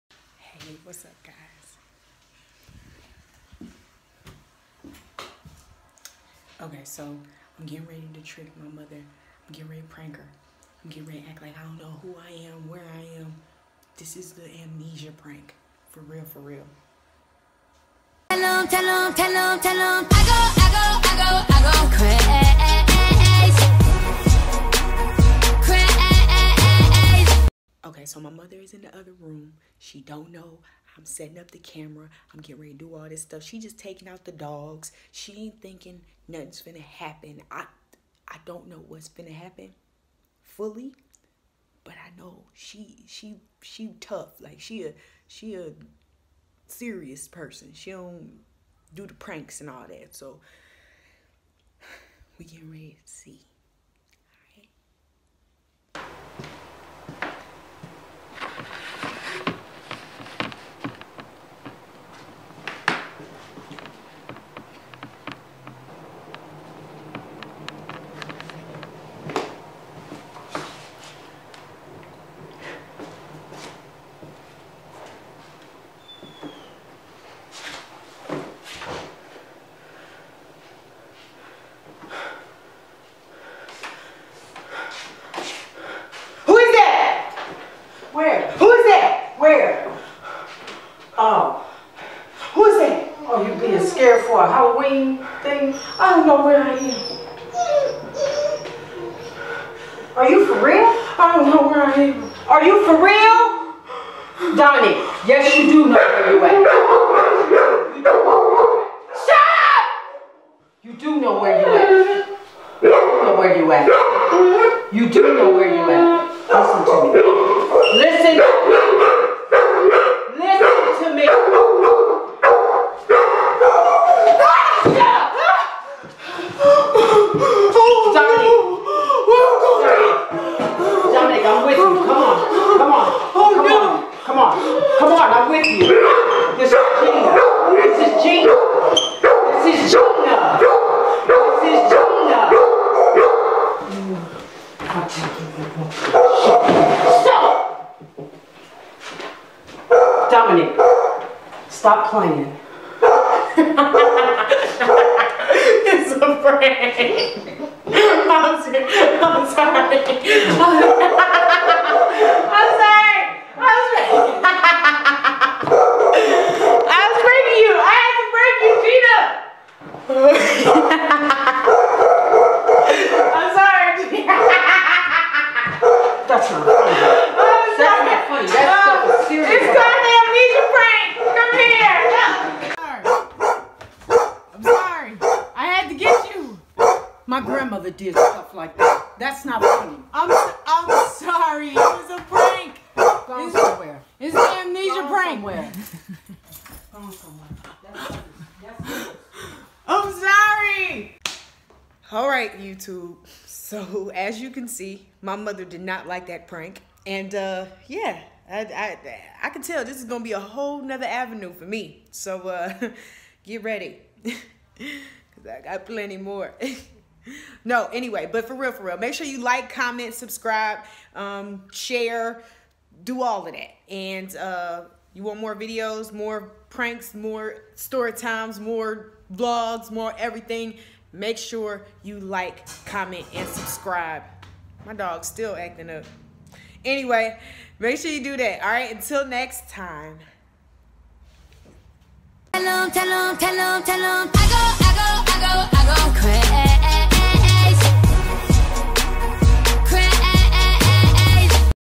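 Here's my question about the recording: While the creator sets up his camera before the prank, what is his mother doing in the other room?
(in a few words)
taking out the dogs.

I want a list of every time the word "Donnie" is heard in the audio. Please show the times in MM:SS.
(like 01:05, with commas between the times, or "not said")
01:44.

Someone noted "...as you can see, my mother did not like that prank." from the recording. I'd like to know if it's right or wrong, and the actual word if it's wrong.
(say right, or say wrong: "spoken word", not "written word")
right.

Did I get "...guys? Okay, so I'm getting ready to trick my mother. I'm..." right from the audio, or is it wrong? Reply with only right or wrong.
right.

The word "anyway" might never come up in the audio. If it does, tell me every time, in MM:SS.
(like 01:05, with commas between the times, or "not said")
03:37, 03:56.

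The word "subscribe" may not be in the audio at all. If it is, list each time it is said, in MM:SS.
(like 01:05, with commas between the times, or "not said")
03:40, 03:53.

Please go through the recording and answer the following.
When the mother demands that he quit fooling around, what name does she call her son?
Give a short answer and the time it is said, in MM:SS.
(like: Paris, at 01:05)
Dominique, at 02:30.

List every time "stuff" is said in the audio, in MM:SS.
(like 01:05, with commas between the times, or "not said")
00:33, 03:08.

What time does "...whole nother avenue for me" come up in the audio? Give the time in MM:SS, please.
03:30.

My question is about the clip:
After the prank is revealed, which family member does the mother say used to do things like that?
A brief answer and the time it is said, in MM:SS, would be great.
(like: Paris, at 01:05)
grandmother, at 03:07.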